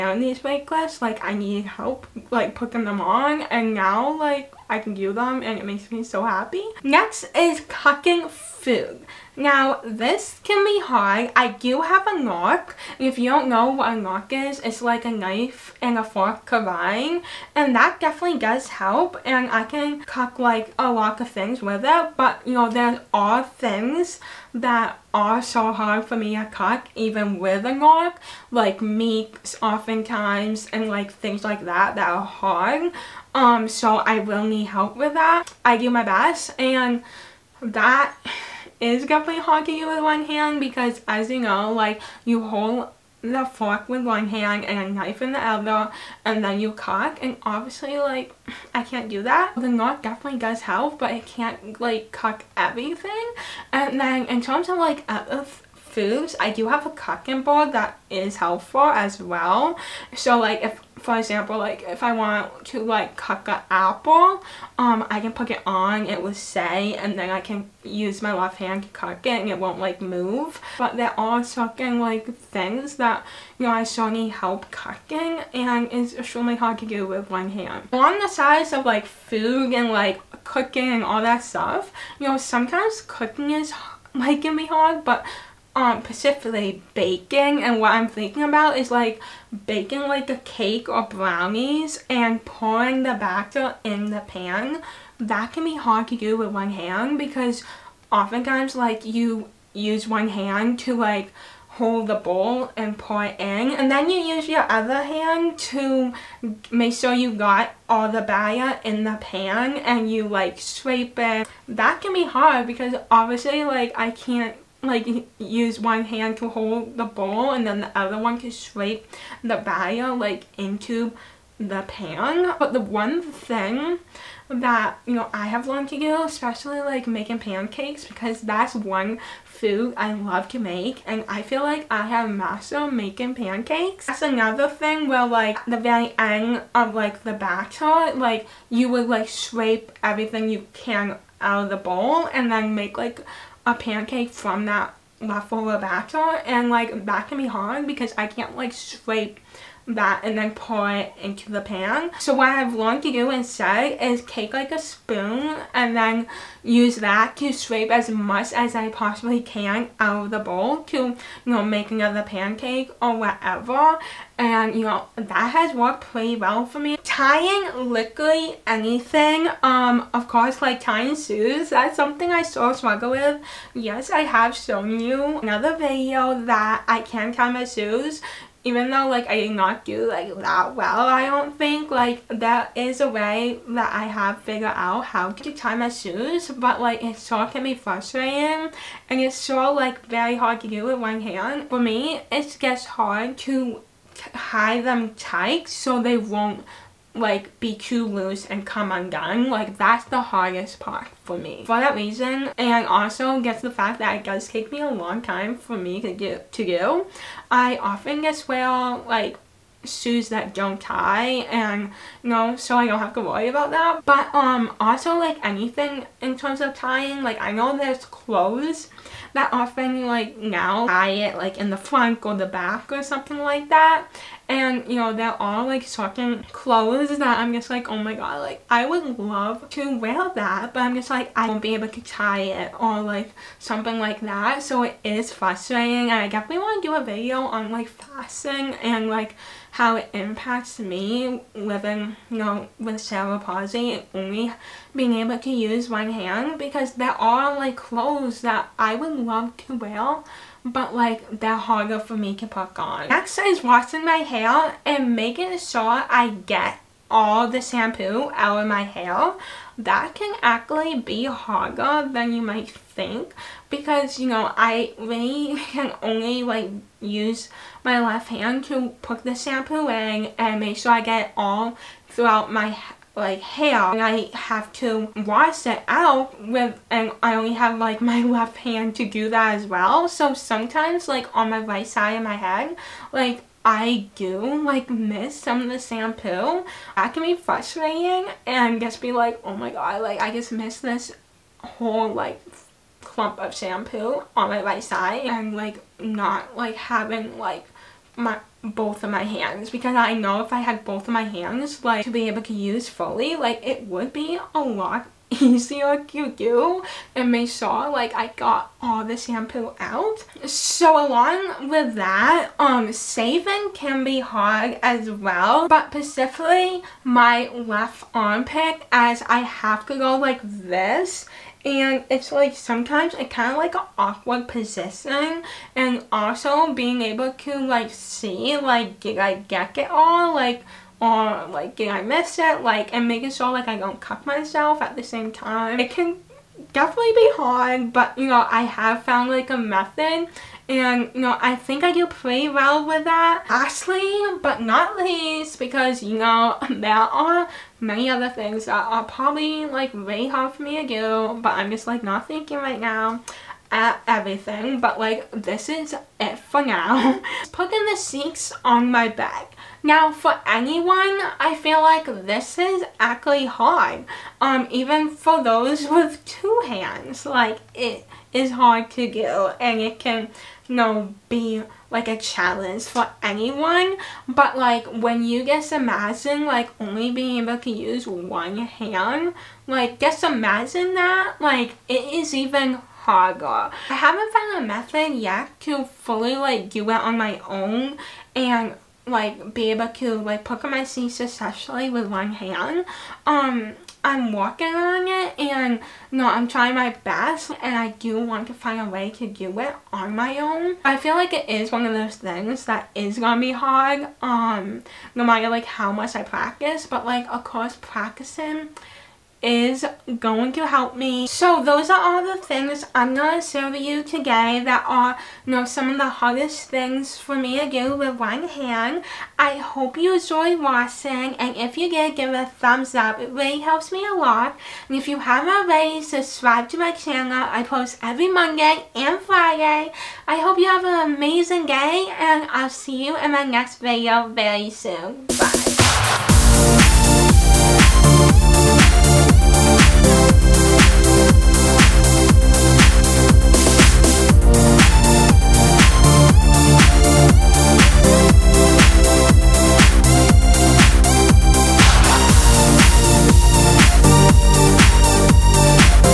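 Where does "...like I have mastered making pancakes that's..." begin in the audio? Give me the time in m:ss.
2:11.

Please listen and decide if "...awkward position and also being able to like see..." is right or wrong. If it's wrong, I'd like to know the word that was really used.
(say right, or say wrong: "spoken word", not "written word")
right.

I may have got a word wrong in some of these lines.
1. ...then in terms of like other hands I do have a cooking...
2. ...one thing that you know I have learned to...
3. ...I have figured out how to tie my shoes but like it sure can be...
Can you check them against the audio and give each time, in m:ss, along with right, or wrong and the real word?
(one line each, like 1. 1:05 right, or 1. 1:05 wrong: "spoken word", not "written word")
1. 0:53 wrong: "foods", not "hands"
2. 2:02 right
3. 3:03 right.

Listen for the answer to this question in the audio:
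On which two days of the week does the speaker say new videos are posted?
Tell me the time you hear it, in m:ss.
7:08.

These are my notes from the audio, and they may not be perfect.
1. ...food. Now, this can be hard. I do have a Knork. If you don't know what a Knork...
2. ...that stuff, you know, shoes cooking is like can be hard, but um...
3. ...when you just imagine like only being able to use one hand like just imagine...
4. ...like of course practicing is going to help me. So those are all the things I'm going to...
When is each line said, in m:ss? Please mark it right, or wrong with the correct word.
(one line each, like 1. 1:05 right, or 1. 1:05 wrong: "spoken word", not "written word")
1. 0:08 right
2. 1:21 wrong: "sometimes", not "shoes"
3. 6:14 right
4. 6:47 right.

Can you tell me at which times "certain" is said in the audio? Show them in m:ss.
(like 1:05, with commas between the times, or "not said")
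1:11, 3:45.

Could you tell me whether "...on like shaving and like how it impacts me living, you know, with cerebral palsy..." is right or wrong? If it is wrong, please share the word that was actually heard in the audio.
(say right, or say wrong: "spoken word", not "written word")
wrong: "fasting", not "shaving".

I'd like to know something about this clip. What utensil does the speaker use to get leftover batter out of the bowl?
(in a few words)
spoon.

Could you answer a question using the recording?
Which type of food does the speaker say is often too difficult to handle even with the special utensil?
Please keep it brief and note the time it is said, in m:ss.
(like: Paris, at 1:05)
meats, at 0:28.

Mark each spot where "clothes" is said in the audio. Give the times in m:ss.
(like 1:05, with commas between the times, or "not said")
3:38, 3:46, 4:07.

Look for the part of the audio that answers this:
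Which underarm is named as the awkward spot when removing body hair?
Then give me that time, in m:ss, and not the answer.
5:17.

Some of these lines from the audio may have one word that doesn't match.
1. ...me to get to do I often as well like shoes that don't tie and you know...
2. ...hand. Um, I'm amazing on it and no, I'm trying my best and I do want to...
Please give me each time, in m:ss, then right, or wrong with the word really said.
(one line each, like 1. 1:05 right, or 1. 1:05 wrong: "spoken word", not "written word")
1. 3:25 right
2. 6:32 wrong: "working", not "amazing".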